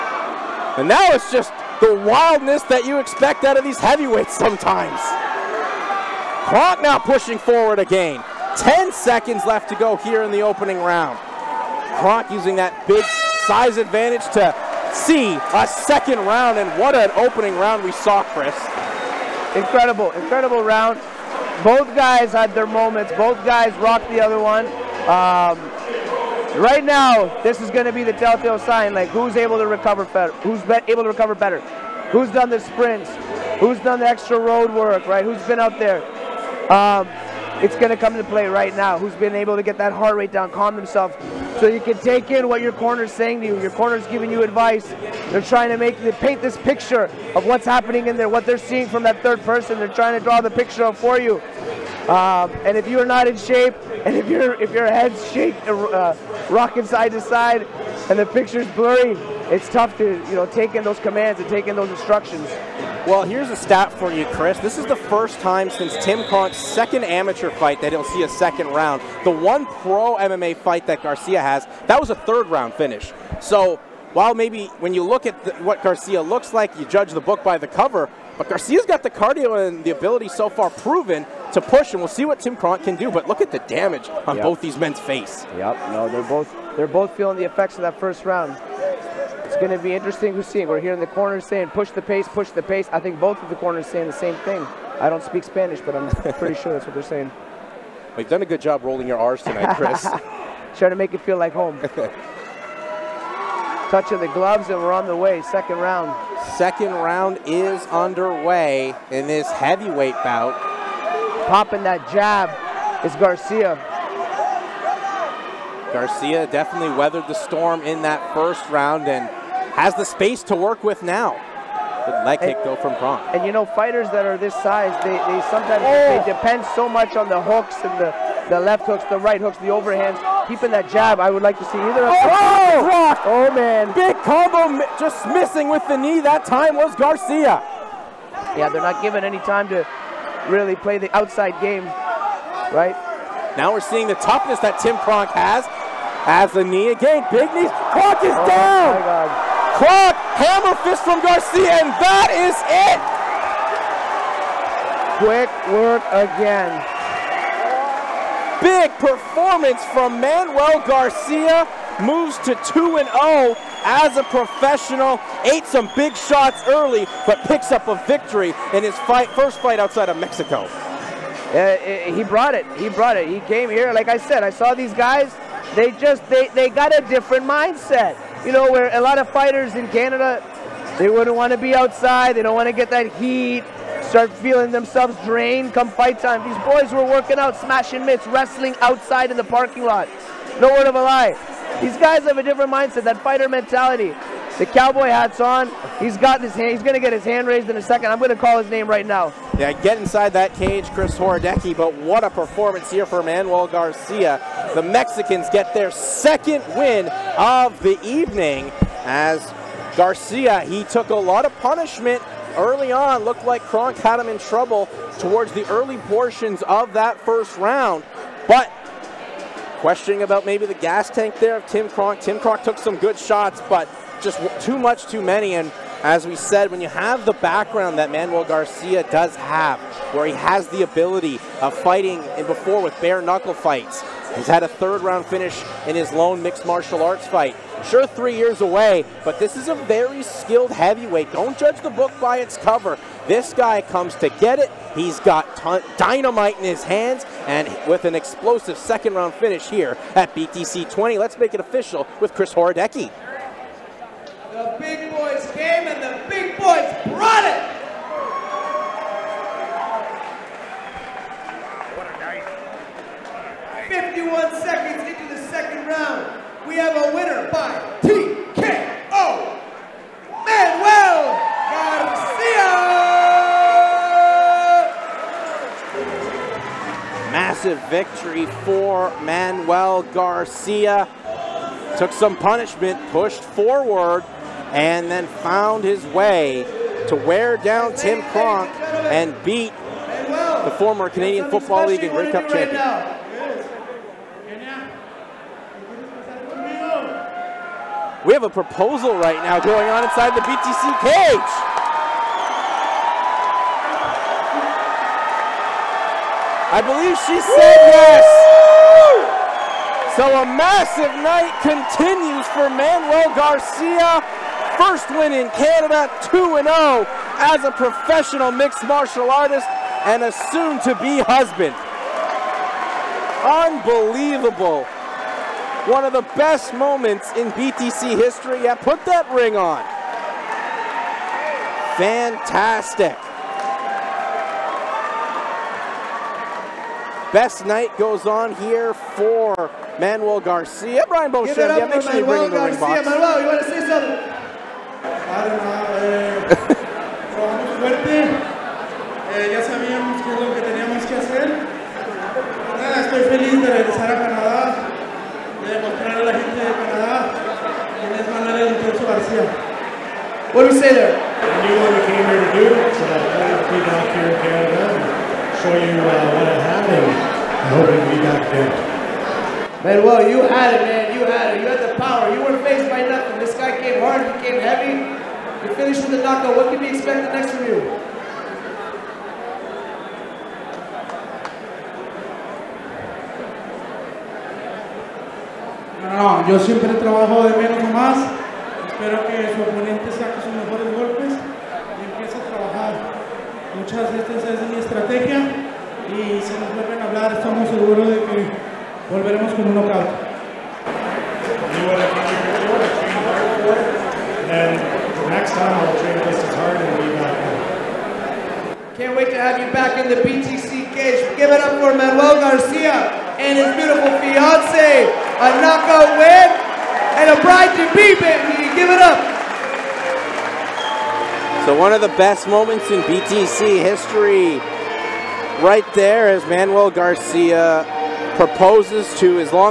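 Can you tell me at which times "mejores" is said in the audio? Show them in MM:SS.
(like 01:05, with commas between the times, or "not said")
06:30.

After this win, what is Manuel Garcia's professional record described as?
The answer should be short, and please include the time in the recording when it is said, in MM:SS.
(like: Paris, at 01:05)
2 and 0, at 02:42.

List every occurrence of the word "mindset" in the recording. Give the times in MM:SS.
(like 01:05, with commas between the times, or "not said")
02:57, 03:12.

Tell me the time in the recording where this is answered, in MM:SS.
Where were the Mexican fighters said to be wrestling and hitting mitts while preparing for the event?
03:09.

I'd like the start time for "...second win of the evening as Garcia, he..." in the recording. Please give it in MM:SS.
03:25.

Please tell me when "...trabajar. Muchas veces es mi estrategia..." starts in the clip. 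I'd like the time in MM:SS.
06:32.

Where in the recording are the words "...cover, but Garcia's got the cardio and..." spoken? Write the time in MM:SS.
01:17.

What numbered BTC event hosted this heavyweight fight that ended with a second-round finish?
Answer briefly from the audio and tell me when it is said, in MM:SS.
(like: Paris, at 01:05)
BTC 20, at 04:10.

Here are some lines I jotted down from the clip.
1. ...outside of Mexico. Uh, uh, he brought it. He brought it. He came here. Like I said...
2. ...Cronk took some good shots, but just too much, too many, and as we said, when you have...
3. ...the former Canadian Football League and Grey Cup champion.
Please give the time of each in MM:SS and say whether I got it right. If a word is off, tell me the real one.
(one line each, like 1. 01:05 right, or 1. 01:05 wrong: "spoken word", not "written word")
1. 02:49 right
2. 03:42 right
3. 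04:50 right.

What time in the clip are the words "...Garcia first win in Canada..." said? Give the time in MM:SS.
05:13.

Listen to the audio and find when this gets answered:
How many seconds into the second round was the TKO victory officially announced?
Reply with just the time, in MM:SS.
04:23.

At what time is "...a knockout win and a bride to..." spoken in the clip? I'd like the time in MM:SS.
06:55.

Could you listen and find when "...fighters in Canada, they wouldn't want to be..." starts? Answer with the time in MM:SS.
02:59.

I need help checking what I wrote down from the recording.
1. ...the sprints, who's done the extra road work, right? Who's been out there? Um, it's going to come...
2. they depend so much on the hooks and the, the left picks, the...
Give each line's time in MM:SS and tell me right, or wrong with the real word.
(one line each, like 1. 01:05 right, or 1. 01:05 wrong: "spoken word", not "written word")
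1. 00:32 right
2. 02:06 wrong: "hooks", not "picks".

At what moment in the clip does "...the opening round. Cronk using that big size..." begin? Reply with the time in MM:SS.
00:10.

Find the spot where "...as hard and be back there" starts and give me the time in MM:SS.
06:46.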